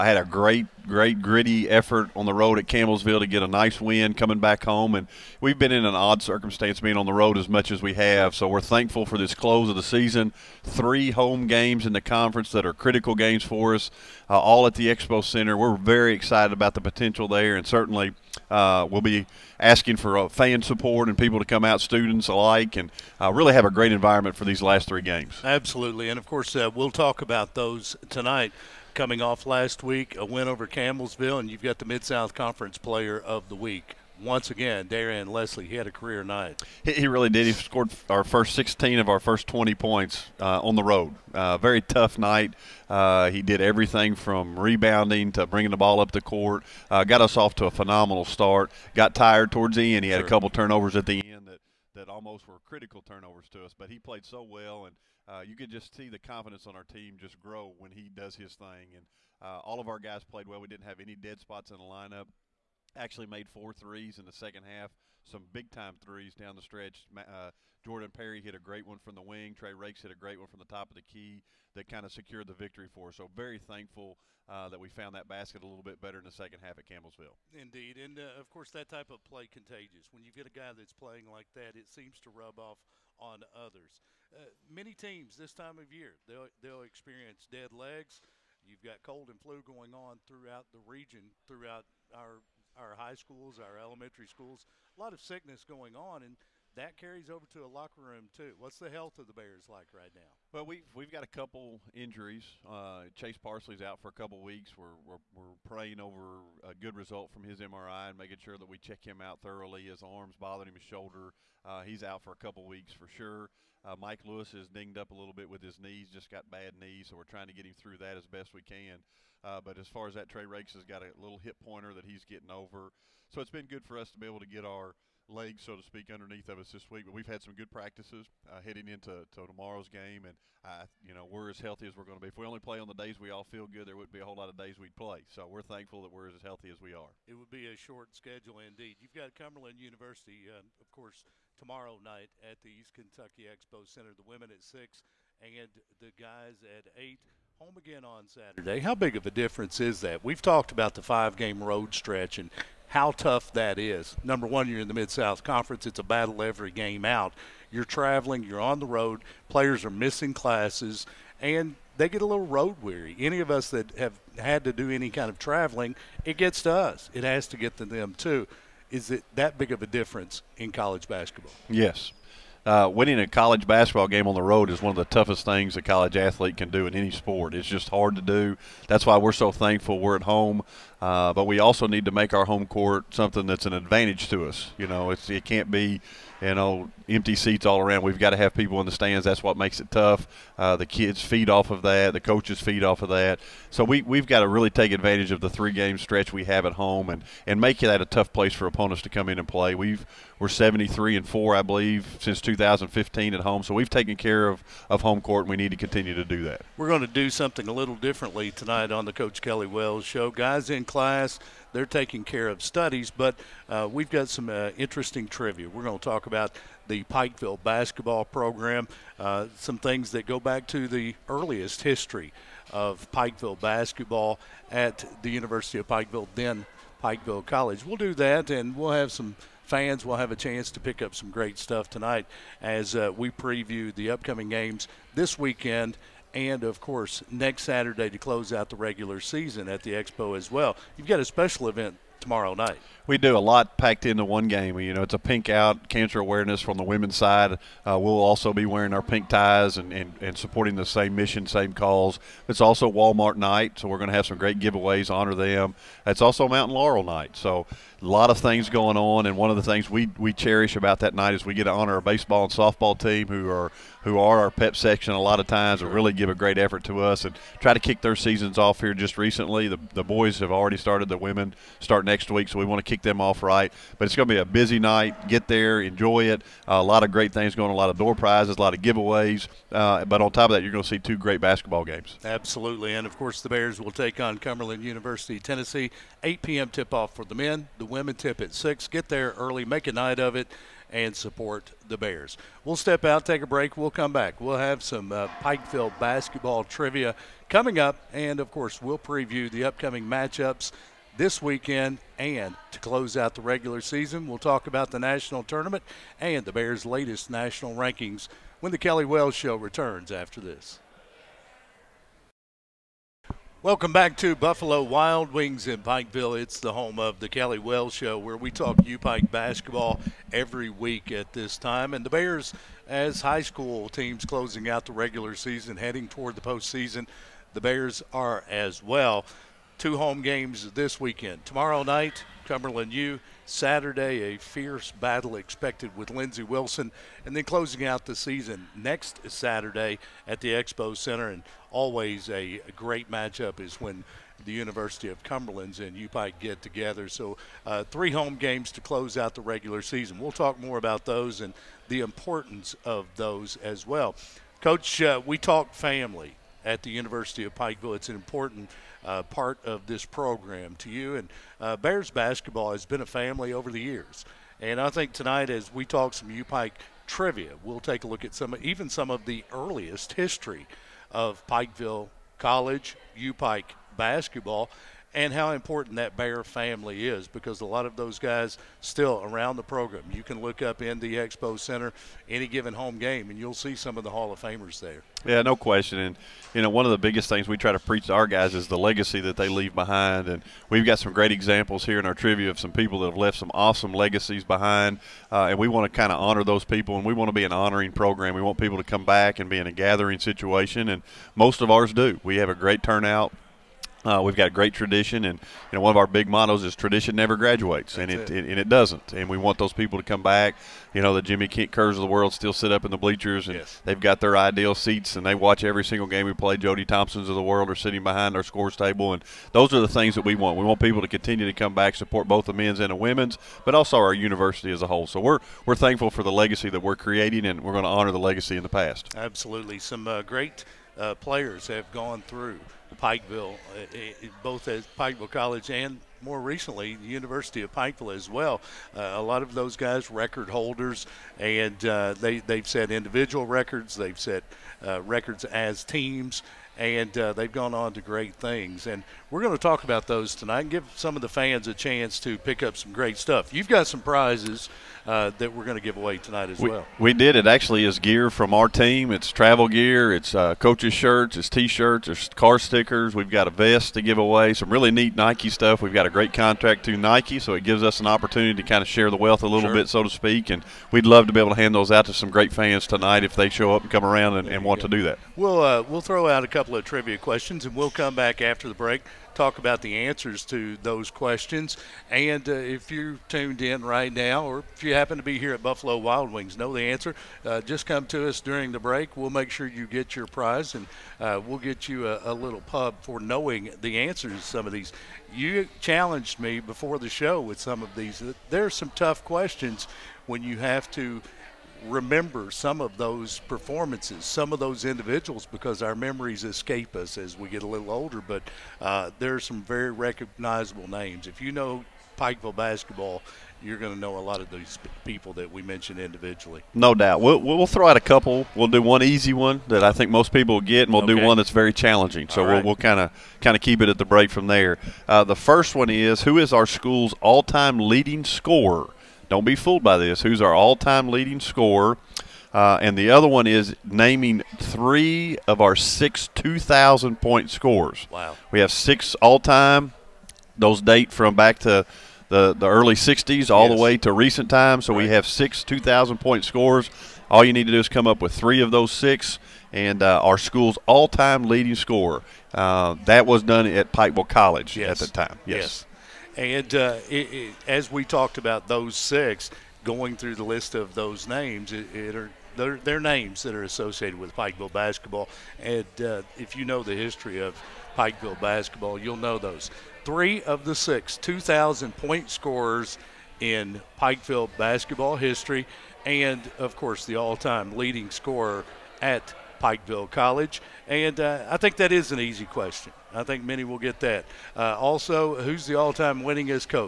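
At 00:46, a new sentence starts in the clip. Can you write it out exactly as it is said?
Uh, got us off to a phenomenal start.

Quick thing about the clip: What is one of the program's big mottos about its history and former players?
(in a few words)
Tradition never graduates.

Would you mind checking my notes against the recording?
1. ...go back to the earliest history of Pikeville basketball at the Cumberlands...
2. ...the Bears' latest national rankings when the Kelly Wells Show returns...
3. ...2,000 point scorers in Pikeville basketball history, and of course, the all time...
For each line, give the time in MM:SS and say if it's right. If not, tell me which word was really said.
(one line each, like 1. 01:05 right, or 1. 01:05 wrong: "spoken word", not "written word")
1. 03:40 wrong: "University", not "Cumberlands"
2. 05:06 right
3. 09:31 right.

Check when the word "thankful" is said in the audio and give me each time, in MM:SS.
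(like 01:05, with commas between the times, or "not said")
00:08, 01:13, 02:15, 02:59, 07:05.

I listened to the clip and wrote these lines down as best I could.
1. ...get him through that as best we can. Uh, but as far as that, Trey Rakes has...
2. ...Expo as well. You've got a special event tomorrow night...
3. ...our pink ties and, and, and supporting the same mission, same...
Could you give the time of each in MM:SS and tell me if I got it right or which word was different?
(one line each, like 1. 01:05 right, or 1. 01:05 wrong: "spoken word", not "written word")
1. 01:57 right
2. 03:59 right
3. 04:08 right.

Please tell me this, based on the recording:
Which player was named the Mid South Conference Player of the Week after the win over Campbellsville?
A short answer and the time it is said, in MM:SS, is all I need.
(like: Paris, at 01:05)
Darian Leslie, at 00:34.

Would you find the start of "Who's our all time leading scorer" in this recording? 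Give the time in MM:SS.
08:50.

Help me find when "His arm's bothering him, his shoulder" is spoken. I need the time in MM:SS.
01:49.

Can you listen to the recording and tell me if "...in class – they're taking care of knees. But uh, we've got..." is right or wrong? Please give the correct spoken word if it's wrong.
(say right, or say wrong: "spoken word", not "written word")
wrong: "studies", not "knees".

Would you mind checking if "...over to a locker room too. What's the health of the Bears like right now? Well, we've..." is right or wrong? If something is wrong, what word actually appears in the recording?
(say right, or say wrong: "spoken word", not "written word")
right.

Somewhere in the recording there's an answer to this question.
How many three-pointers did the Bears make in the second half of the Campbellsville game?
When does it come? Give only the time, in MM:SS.
01:03.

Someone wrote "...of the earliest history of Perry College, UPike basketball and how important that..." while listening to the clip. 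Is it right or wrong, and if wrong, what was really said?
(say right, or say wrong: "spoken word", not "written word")
wrong: "Pikeville", not "Perry".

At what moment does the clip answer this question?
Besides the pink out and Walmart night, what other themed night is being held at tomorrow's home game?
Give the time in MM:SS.
04:16.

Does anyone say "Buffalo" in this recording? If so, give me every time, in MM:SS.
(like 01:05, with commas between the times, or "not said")
05:14, 08:05.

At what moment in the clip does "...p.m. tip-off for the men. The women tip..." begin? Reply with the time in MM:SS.
04:46.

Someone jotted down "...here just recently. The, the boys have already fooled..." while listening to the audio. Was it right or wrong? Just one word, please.
wrong.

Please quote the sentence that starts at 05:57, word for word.
It's an important uh, part of this program to you.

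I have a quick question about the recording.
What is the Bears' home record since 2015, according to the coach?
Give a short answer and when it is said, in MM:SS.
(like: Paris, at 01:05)
73 and 4, at 03:20.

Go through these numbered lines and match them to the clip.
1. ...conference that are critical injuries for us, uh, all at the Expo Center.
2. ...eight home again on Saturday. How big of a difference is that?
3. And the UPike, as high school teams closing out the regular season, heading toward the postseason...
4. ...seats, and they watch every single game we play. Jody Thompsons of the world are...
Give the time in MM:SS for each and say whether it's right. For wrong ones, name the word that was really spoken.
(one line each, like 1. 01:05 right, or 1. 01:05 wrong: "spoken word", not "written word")
1. 00:11 wrong: "games", not "injuries"
2. 02:26 right
3. 05:21 wrong: "Bears", not "UPike"
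4. 06:54 right.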